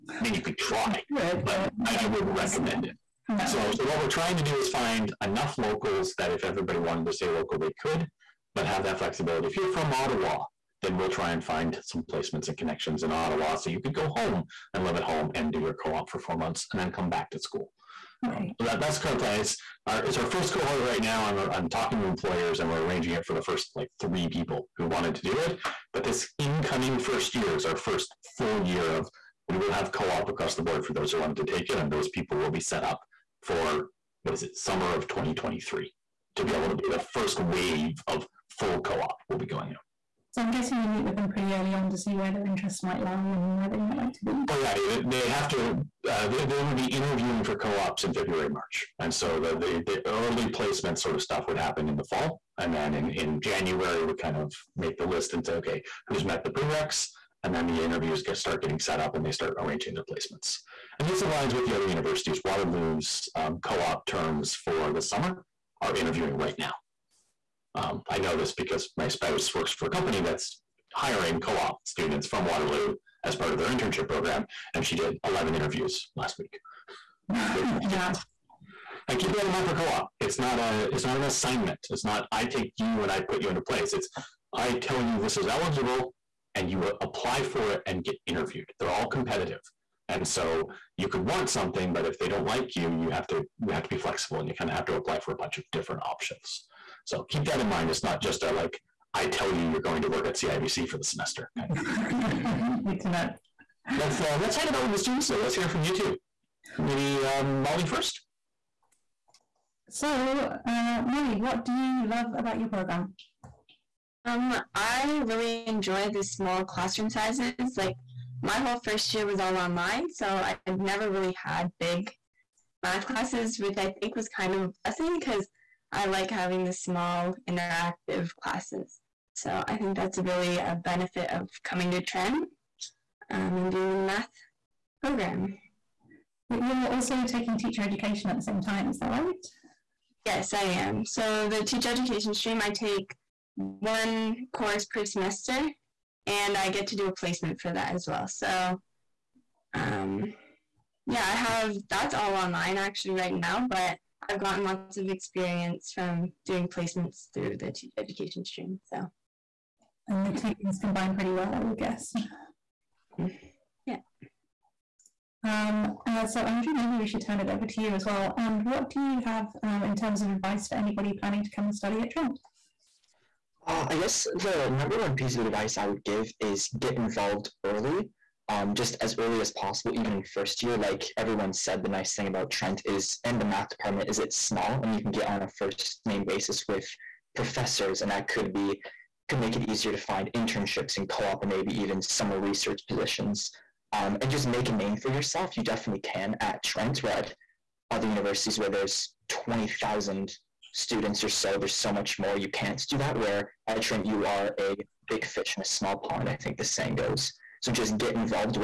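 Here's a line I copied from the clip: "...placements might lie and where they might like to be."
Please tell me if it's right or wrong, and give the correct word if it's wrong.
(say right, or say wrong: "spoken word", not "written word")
wrong: "interests", not "placements".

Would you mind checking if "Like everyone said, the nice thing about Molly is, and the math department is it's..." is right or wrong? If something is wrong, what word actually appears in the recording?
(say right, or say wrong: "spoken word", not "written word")
wrong: "Trent", not "Molly".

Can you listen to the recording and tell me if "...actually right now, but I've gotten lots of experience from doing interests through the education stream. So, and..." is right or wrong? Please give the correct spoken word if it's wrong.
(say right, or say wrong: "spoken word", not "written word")
wrong: "placements", not "interests".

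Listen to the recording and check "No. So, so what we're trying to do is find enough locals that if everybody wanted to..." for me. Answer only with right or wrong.
right.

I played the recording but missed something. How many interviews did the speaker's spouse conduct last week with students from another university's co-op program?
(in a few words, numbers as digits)
11.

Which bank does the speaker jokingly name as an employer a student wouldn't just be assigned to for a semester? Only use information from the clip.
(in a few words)
CIBC.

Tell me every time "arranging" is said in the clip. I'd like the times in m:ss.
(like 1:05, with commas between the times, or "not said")
0:22, 0:59.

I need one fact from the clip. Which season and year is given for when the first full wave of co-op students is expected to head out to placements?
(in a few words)
summer of 2023.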